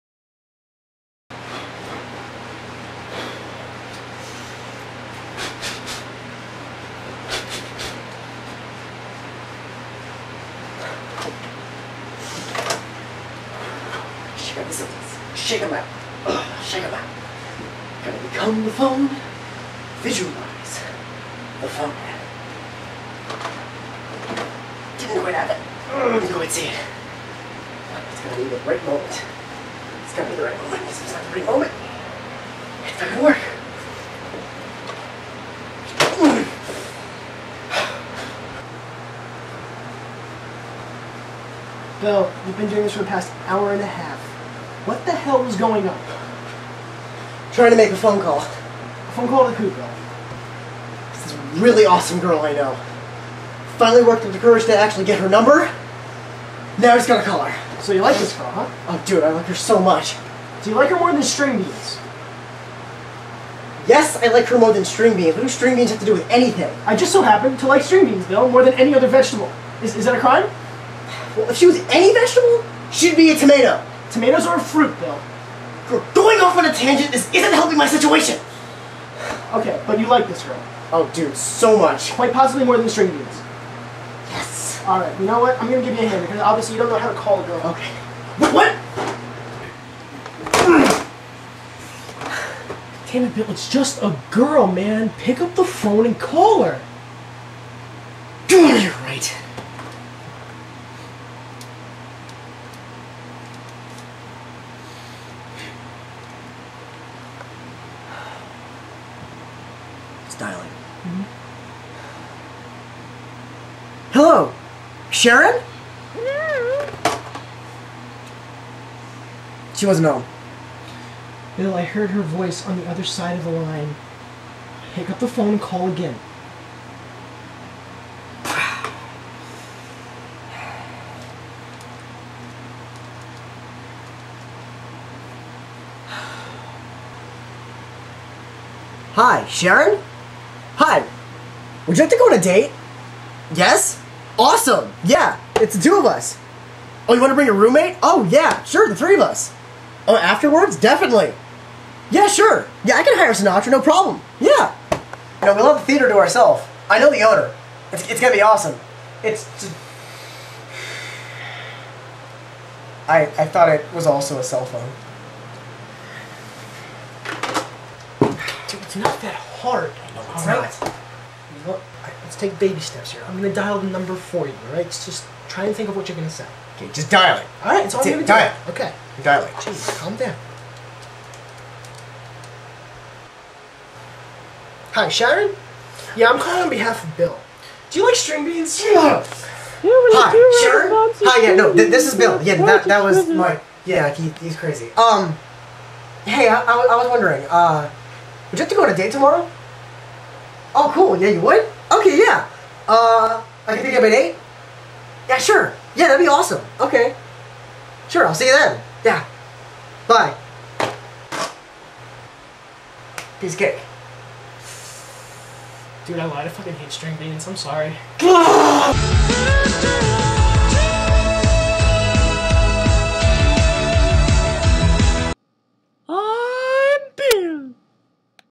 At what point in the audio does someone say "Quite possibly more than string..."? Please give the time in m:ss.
1:22.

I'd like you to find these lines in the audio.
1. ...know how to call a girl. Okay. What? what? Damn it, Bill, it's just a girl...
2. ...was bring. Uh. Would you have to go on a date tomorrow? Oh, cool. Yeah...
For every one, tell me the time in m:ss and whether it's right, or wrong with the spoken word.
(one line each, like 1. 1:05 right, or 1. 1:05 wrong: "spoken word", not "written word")
1. 1:26 right
2. 3:17 wrong: "wondering", not "bring".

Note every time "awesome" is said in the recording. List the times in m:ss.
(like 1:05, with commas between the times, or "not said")
0:51, 2:24, 2:38, 3:26.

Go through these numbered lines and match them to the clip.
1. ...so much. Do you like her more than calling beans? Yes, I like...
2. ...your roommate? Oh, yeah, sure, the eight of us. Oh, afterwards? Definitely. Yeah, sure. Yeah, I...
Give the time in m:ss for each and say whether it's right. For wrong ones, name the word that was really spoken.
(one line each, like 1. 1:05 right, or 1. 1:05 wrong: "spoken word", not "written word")
1. 0:59 wrong: "string", not "calling"
2. 2:27 wrong: "three", not "eight".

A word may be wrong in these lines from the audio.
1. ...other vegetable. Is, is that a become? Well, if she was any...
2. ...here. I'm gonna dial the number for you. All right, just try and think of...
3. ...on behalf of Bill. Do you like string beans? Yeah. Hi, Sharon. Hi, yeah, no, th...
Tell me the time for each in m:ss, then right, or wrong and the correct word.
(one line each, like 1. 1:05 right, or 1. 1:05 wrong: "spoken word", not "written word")
1. 1:08 wrong: "crime", not "become"
2. 2:53 right
3. 3:06 right.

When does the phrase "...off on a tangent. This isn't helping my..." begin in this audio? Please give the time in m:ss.
1:16.